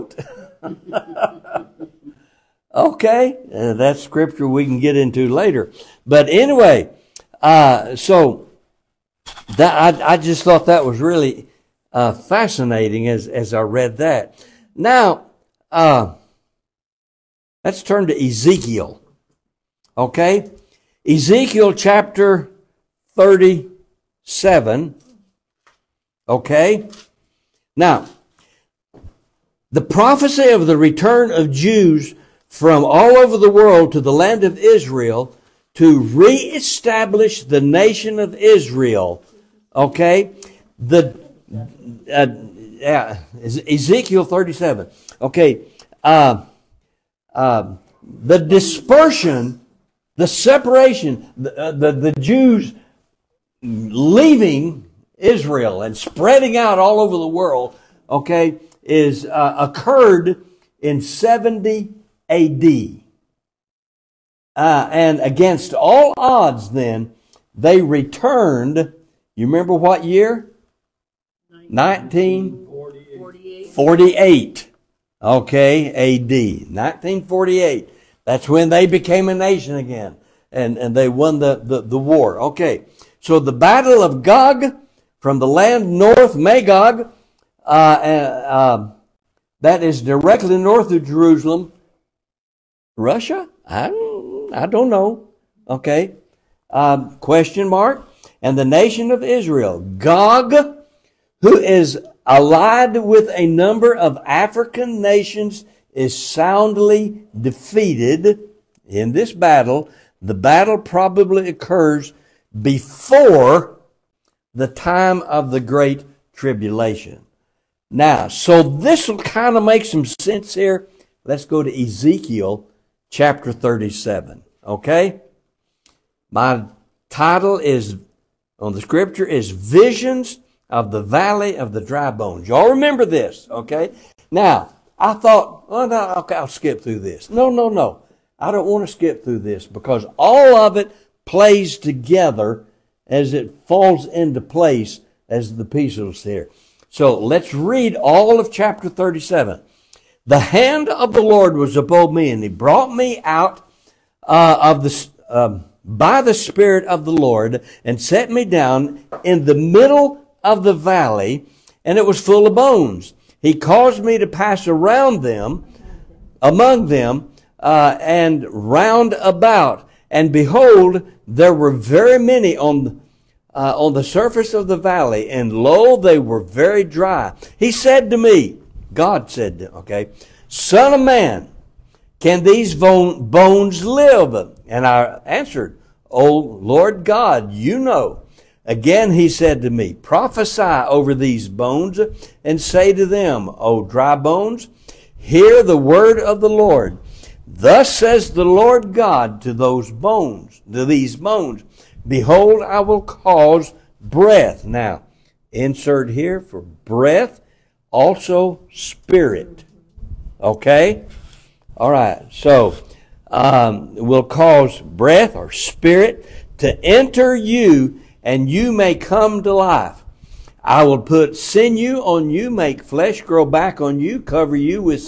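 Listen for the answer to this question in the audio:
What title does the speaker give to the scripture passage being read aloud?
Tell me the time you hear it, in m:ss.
2:09.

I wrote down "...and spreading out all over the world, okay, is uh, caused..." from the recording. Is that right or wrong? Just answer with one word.
wrong.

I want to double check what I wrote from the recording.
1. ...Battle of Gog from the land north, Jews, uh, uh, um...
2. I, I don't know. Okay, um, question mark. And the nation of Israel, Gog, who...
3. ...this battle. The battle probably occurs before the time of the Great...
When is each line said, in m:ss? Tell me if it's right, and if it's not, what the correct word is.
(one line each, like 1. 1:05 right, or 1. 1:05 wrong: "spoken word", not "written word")
1. 1:23 wrong: "Magog", not "Jews"
2. 1:33 right
3. 1:49 right.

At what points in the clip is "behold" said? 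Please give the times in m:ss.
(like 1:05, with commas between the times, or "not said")
2:50, 3:22.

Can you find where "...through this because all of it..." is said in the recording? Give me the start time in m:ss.
2:19.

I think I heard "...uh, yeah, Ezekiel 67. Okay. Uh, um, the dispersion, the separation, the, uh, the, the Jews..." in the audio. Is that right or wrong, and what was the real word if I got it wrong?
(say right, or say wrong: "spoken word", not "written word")
wrong: "37", not "67".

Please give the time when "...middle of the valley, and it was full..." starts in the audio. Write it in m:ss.
2:39.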